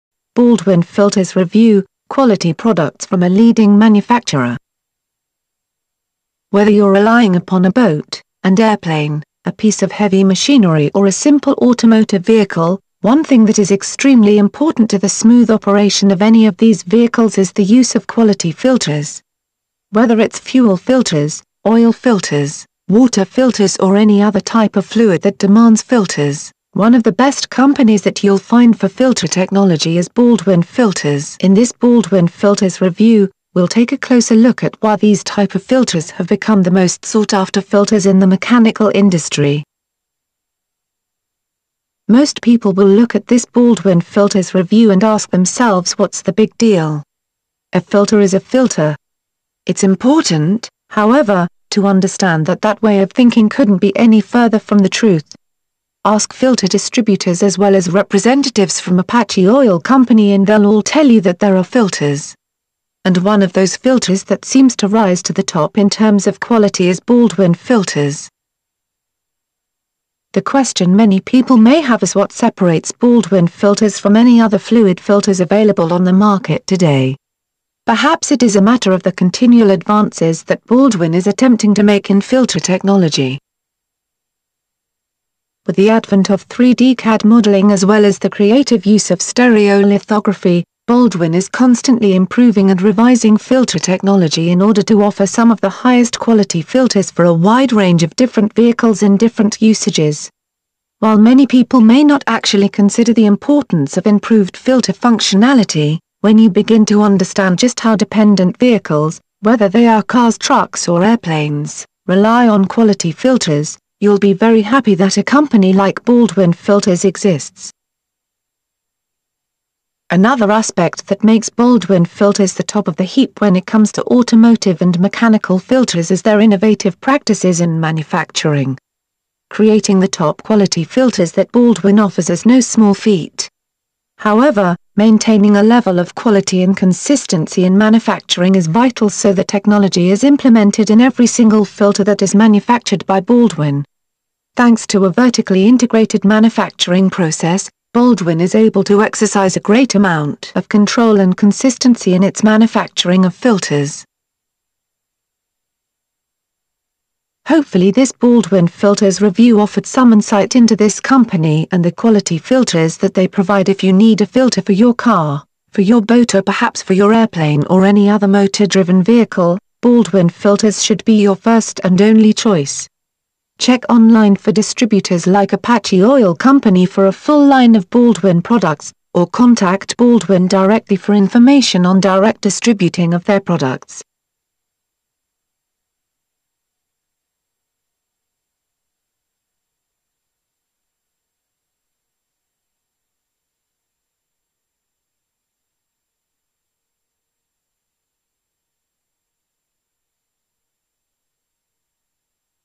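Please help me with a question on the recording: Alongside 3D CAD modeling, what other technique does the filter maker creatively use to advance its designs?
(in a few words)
stereolithography.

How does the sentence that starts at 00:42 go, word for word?
Most people will look at this Baldwin Filters review and ask themselves what's the big deal.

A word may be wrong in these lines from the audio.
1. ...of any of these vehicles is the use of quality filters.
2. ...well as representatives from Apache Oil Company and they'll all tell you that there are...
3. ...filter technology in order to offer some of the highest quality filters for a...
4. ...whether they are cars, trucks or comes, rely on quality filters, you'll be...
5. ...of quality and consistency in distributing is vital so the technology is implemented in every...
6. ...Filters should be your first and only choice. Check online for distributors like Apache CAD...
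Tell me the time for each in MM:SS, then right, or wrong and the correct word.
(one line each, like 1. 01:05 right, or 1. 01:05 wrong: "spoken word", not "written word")
1. 00:16 right
2. 00:57 right
3. 01:33 right
4. 01:49 wrong: "airplanes", not "comes"
5. 02:15 wrong: "manufacturing", not "distributing"
6. 02:50 wrong: "Oil", not "CAD".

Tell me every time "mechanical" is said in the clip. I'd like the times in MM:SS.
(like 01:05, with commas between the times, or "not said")
00:38, 02:04.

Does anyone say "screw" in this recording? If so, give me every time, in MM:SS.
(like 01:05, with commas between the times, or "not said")
not said.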